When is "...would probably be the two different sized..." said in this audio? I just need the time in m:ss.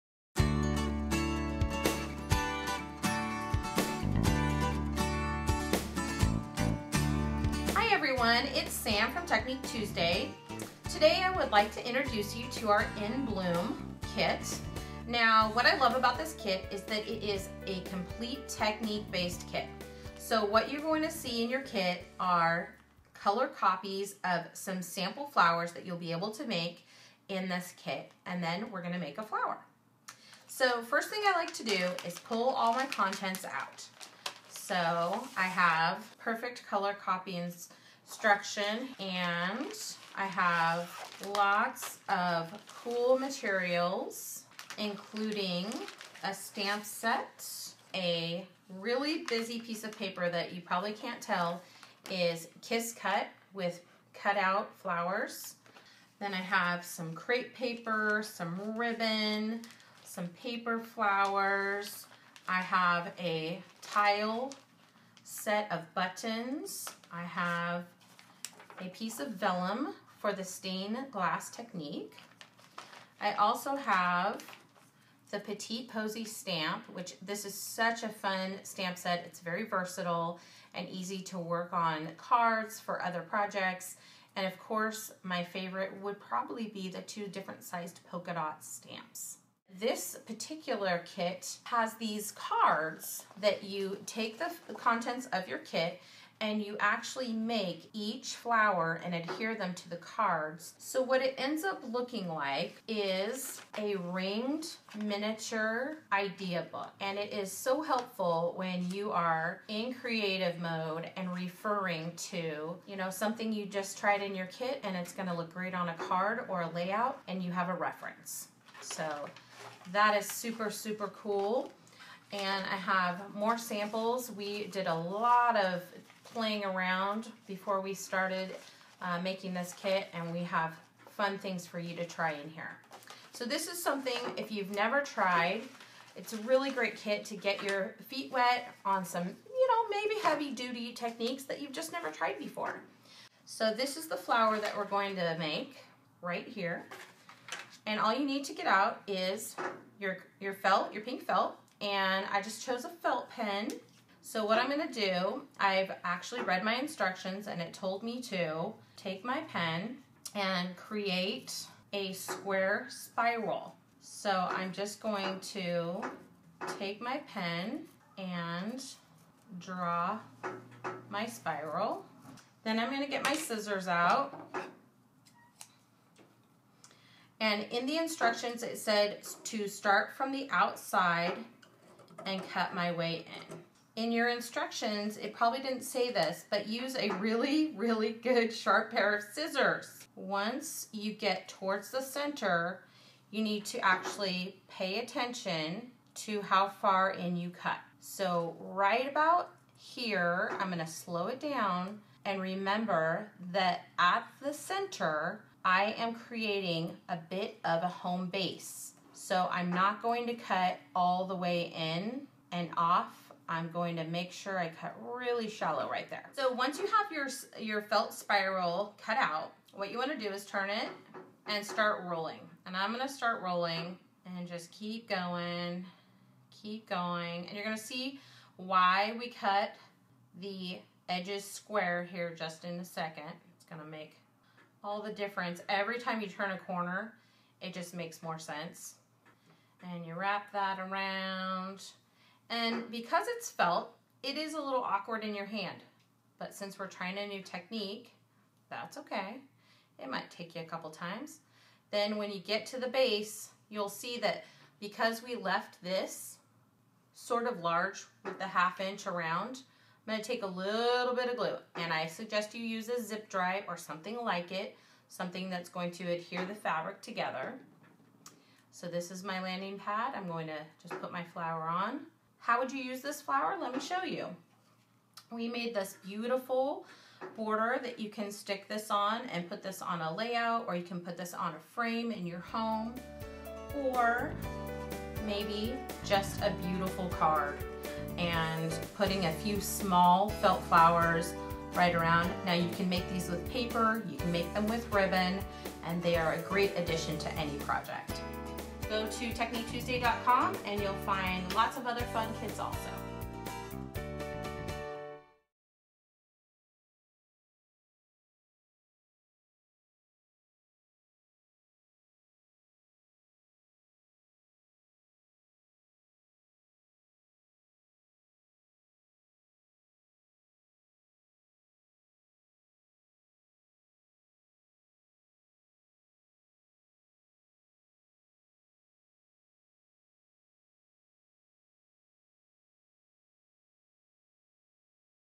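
1:26.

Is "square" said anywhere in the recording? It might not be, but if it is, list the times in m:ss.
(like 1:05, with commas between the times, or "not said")
2:42, 3:51.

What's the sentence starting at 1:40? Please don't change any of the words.
So what it ends up looking like is a ringed miniature idea book.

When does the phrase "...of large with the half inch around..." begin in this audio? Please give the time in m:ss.
4:17.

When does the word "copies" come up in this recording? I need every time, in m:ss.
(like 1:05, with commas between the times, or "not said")
0:23, 0:36.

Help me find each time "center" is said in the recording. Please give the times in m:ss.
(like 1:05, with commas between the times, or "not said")
3:11, 3:24.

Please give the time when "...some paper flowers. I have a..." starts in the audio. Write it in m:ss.
1:00.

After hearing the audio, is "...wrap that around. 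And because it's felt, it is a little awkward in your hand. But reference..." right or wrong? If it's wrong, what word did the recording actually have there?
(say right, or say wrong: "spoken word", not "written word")
wrong: "since", not "reference".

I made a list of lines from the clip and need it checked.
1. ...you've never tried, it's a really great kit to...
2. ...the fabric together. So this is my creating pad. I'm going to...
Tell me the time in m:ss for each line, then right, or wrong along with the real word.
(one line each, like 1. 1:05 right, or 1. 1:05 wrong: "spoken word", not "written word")
1. 2:14 right
2. 4:26 wrong: "landing", not "creating".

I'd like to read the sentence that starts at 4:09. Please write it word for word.
It might take you a couple times.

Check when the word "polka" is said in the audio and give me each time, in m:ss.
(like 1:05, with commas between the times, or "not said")
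1:28.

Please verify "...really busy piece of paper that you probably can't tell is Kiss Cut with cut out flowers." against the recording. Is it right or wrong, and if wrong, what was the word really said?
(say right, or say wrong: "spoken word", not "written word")
right.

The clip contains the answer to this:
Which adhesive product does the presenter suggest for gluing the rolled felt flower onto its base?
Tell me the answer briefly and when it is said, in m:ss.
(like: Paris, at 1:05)
Zip Dry, at 4:23.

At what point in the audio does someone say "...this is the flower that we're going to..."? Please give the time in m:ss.
2:23.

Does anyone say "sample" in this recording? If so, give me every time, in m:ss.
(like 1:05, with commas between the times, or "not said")
0:24, 2:03.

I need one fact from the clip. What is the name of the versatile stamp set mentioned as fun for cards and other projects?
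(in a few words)
Petite Posy.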